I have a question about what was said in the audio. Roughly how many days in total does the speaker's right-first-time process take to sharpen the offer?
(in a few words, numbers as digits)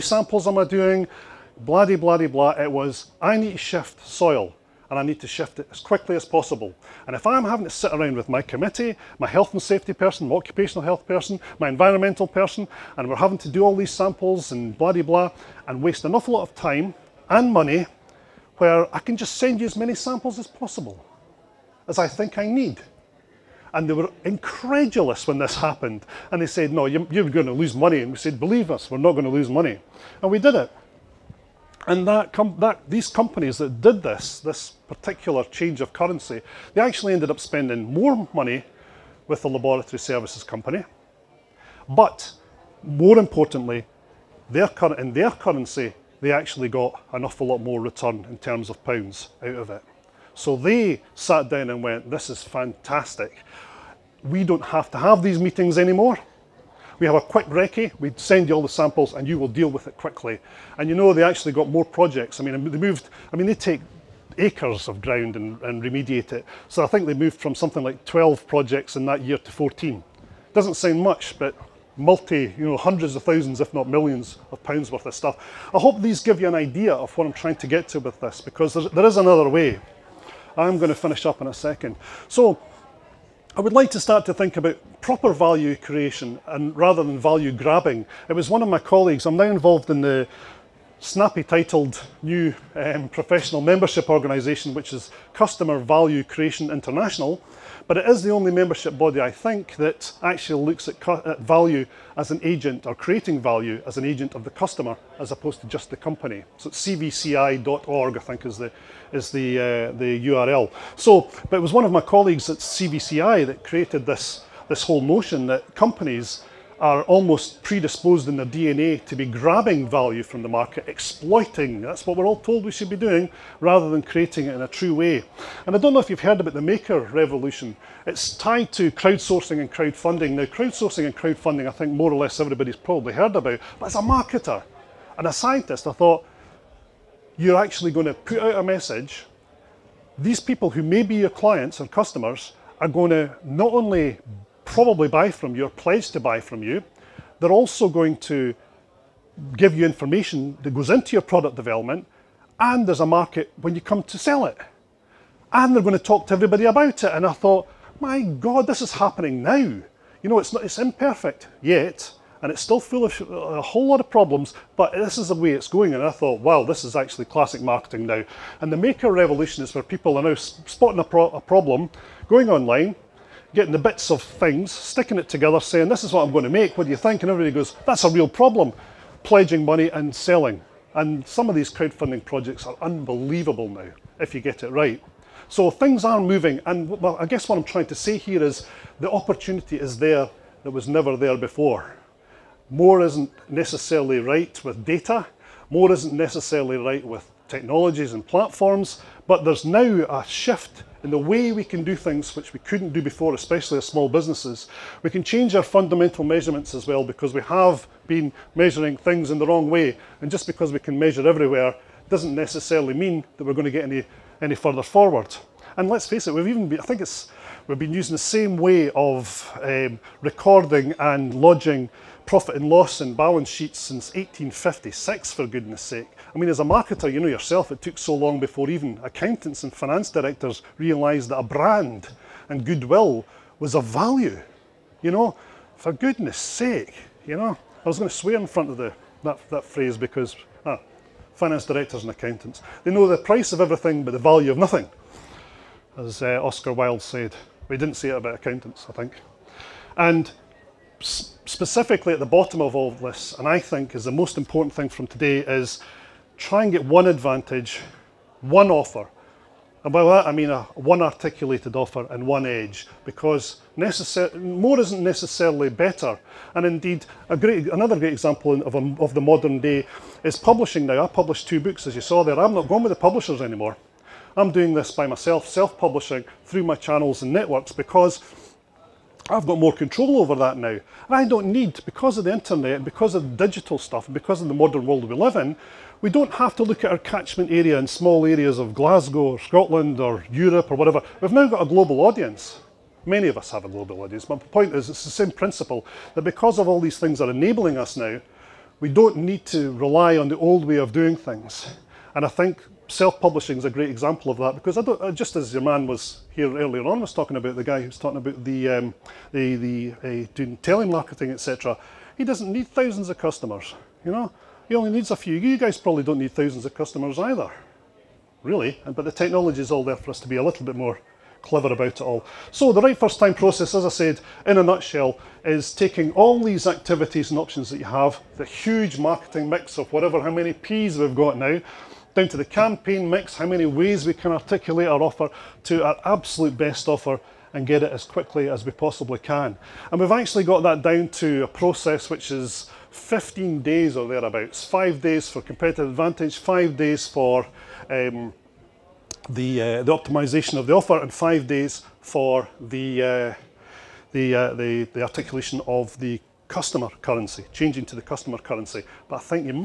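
15 days.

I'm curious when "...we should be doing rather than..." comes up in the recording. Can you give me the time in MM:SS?
02:02.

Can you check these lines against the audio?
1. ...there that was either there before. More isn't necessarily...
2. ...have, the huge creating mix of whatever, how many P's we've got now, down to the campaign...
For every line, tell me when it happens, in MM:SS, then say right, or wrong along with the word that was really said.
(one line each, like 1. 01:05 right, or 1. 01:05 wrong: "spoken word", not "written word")
1. 03:09 wrong: "never", not "either"
2. 05:27 wrong: "marketing", not "creating".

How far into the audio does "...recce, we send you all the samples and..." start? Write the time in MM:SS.
00:57.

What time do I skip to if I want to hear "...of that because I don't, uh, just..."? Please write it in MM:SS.
05:04.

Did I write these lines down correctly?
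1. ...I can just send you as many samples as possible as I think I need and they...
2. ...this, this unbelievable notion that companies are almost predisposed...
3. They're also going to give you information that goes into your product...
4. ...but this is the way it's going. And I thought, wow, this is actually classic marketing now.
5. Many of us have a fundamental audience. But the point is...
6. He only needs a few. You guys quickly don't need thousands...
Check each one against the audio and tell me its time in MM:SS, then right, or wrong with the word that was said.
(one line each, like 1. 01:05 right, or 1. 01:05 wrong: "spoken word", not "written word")
1. 00:18 right
2. 01:54 wrong: "whole", not "unbelievable"
3. 02:27 right
4. 02:44 right
5. 04:53 wrong: "global", not "fundamental"
6. 05:14 wrong: "probably", not "quickly".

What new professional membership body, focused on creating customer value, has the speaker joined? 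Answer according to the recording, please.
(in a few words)
Customer Value Creation International.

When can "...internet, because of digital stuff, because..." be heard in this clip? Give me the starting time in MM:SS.
04:42.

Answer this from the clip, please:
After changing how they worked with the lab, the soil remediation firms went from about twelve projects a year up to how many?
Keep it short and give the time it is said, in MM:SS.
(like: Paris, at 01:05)
14, at 01:09.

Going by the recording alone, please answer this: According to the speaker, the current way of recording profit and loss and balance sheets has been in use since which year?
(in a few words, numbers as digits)
1856.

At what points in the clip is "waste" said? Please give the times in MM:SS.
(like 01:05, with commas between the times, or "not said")
00:15.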